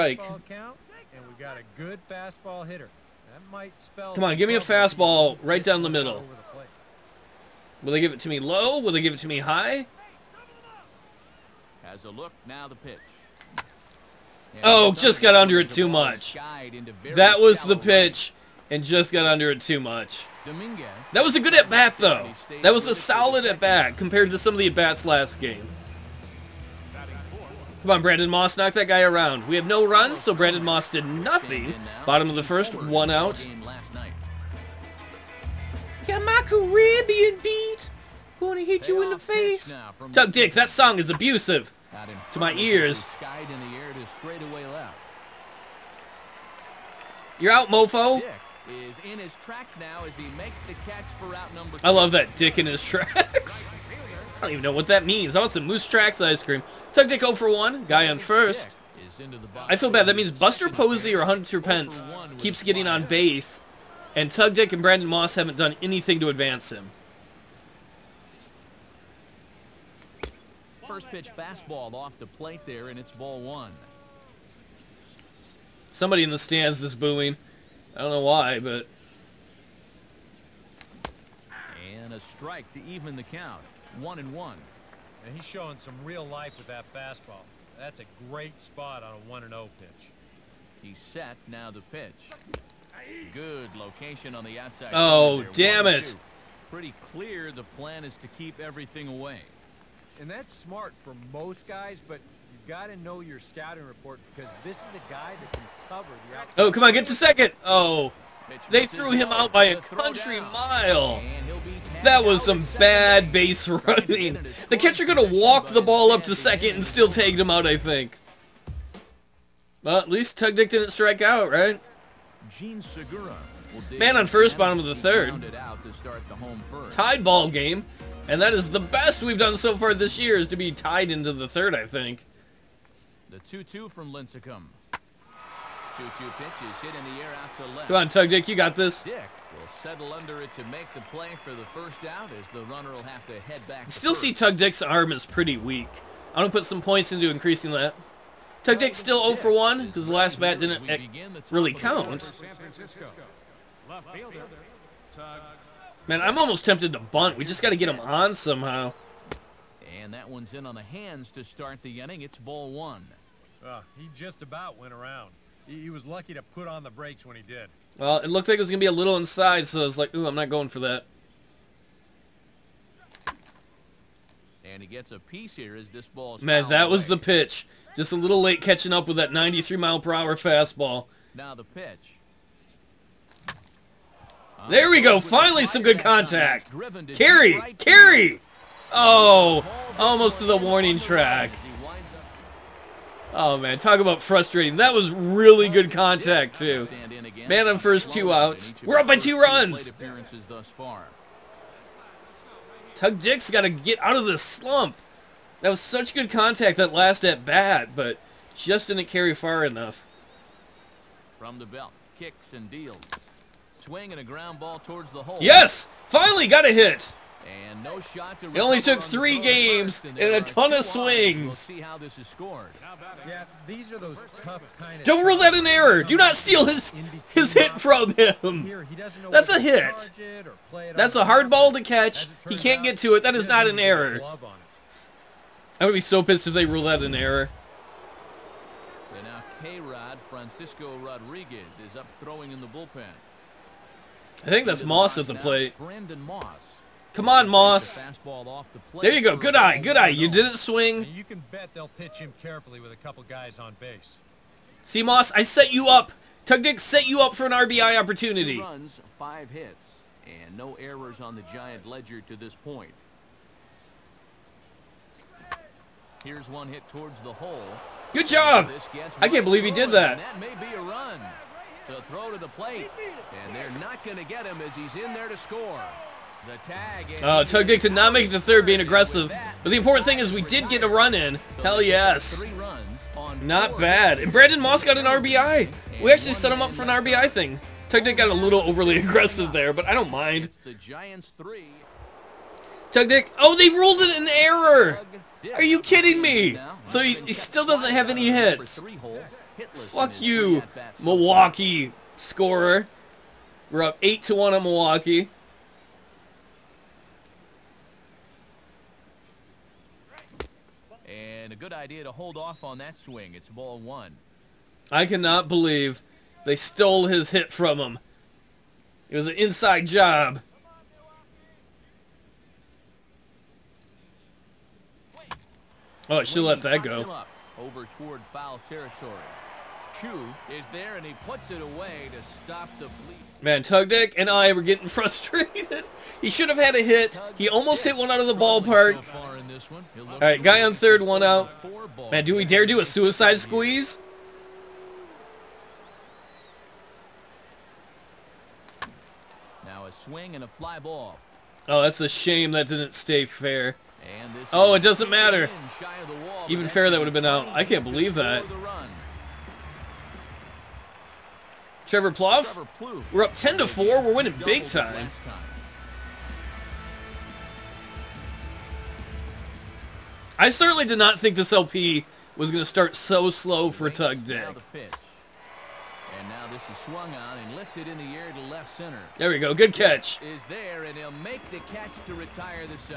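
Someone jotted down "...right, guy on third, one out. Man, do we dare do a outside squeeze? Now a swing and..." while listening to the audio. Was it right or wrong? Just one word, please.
wrong.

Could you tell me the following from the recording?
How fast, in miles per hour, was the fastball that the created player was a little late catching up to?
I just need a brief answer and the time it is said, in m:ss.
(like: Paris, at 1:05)
93, at 2:59.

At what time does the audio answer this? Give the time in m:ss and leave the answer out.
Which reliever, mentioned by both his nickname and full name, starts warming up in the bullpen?
4:00.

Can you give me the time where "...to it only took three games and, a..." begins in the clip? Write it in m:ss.
3:38.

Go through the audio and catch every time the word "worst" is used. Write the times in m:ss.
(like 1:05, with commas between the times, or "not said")
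not said.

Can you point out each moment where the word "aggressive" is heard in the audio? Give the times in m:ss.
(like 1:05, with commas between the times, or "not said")
4:38, 4:48.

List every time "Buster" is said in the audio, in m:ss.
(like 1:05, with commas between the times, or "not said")
1:00.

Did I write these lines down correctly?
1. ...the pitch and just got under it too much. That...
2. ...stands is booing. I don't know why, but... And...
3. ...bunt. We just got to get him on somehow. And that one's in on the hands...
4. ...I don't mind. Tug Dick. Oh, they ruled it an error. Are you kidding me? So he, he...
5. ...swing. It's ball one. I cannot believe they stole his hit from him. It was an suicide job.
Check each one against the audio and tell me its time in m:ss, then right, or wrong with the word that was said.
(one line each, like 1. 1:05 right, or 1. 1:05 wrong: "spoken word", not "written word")
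1. 0:17 right
2. 1:16 right
3. 2:36 right
4. 4:49 right
5. 5:12 wrong: "inside", not "suicide".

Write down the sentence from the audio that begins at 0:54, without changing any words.
I don't even know what that means.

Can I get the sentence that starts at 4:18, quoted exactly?
Two runs, five hits, and no errors on the Giant ledger to this point.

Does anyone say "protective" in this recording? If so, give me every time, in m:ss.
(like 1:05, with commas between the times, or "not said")
not said.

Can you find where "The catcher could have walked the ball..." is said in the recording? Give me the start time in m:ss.
1:54.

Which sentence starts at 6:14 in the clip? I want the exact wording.
And now this is swung on and lifted in the air to left center.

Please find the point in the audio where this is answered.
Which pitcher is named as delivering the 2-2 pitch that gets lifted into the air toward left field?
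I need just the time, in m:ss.
2:14.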